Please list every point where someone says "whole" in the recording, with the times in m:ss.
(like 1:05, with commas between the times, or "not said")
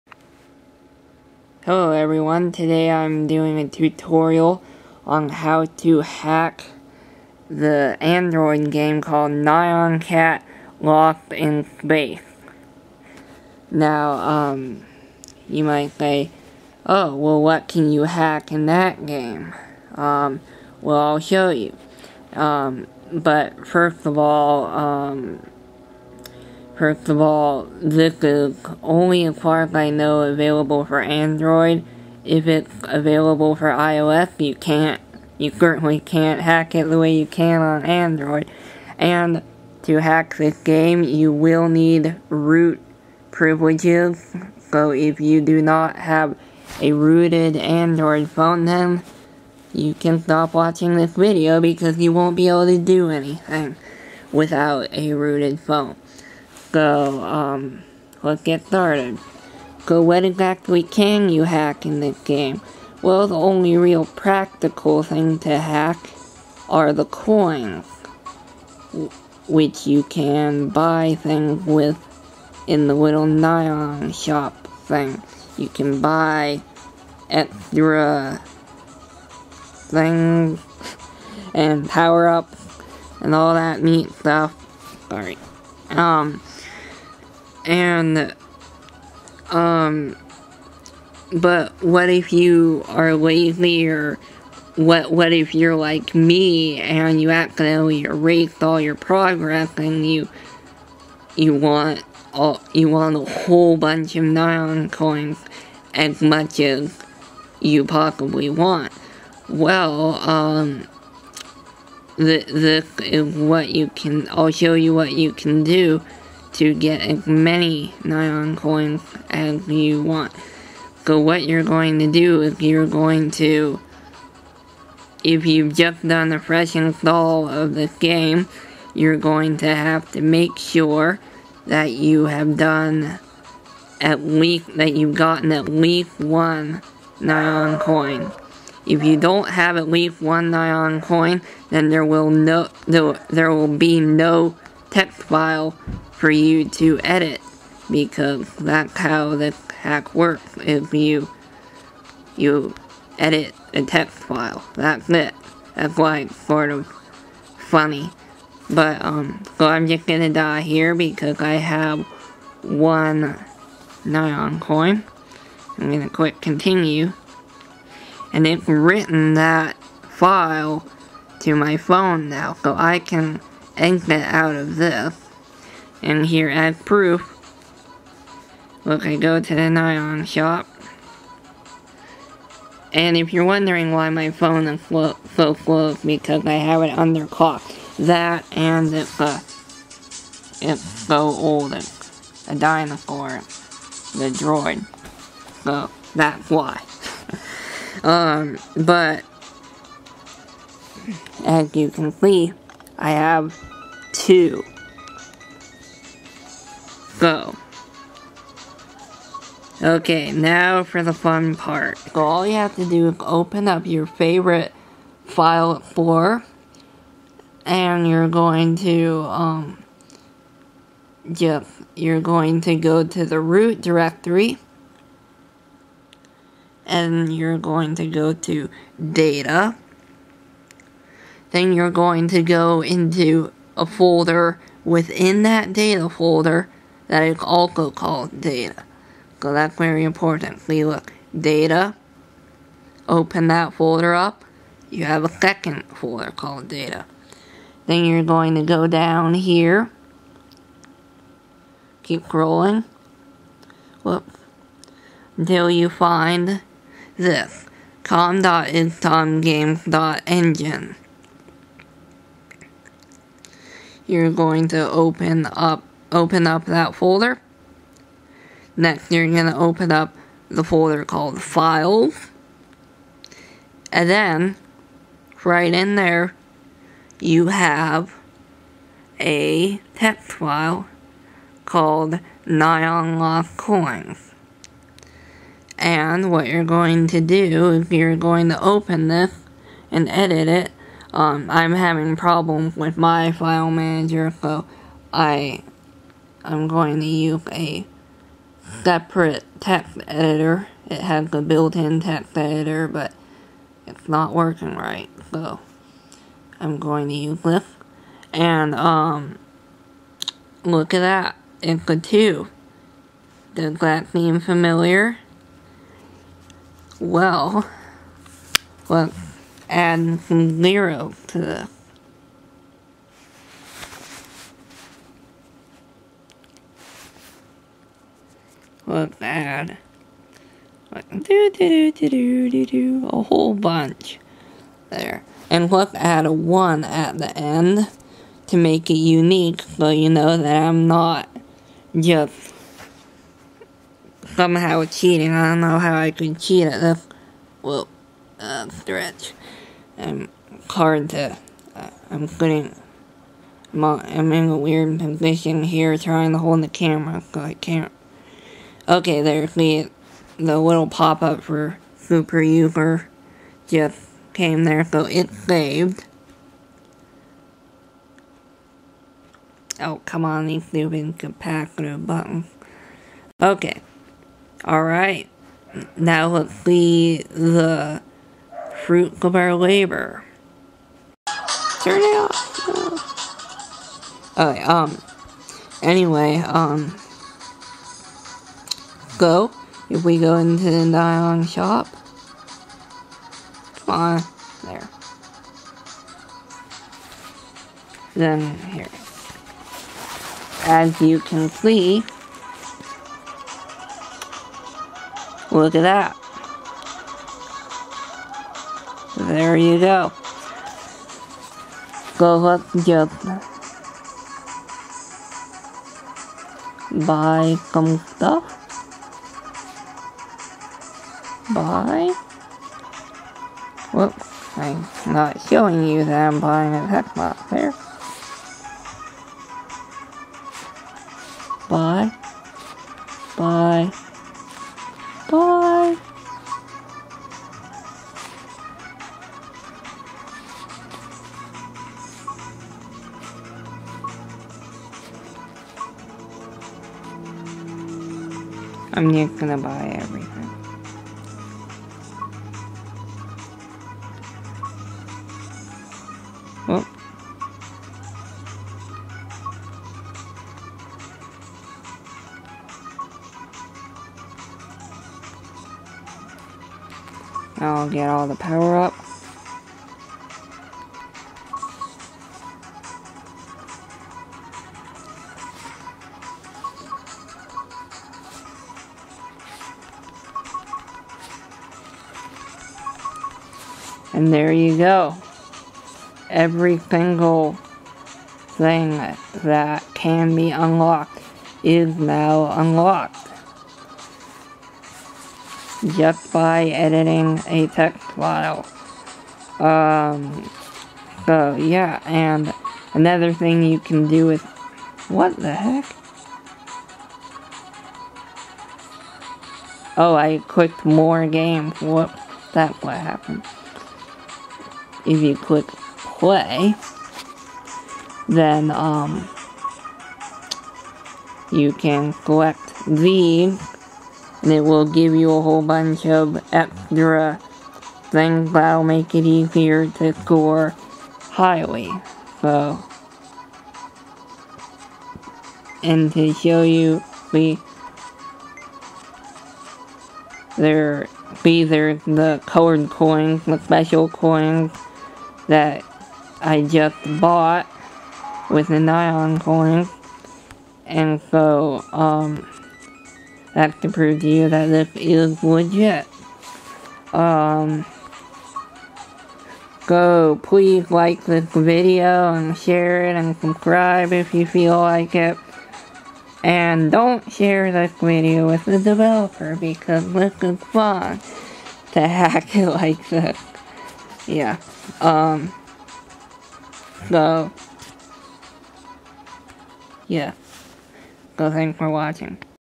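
1:43, 5:33, 8:45.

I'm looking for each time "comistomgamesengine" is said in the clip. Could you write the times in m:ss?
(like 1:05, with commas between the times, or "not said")
4:18.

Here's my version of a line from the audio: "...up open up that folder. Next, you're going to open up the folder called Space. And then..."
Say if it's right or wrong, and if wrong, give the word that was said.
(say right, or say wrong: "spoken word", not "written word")
wrong: "Files", not "Space".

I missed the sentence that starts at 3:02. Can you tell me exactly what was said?
And if you're wondering why my phone is slow, so slow, it's because I have it underclocked.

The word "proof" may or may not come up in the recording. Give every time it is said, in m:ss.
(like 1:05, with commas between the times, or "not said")
2:56.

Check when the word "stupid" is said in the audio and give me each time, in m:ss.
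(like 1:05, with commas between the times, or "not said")
6:10.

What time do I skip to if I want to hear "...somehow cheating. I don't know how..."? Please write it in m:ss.
5:44.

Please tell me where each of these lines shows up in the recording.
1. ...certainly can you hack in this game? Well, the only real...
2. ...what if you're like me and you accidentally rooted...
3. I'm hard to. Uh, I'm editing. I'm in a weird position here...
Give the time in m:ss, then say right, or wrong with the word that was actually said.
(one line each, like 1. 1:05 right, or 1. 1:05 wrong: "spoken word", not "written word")
1. 1:00 wrong: "exactly", not "certainly"
2. 1:35 wrong: "erased", not "rooted"
3. 5:49 wrong: "putting", not "editing".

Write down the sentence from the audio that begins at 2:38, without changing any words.
But um so I'm just gonna die here because I have one nyan coin.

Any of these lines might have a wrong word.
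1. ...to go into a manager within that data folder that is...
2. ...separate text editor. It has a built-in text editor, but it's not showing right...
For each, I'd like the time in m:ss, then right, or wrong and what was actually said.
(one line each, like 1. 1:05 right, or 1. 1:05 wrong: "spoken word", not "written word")
1. 3:52 wrong: "folder", not "manager"
2. 4:58 wrong: "working", not "showing".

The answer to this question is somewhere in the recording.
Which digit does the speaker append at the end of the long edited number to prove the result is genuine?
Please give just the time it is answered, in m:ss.
5:36.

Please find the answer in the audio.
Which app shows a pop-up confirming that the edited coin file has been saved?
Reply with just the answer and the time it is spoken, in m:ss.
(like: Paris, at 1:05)
Superuser, at 6:01.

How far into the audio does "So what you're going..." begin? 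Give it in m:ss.
2:01.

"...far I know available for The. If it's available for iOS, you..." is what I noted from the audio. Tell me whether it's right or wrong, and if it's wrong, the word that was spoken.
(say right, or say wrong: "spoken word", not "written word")
wrong: "Android", not "The".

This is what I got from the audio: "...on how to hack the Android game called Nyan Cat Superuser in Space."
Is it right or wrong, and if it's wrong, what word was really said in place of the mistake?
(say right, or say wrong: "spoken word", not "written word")
wrong: "Lost", not "Superuser".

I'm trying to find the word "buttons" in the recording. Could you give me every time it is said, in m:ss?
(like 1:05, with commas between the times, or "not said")
6:12.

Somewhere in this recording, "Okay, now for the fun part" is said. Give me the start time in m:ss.
3:29.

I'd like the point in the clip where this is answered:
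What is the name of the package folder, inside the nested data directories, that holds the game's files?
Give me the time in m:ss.
4:18.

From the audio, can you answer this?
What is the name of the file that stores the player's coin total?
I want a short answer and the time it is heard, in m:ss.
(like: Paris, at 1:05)
Nyan Lost Coins, at 4:42.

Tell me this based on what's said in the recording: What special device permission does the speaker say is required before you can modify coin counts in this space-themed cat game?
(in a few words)
root privileges.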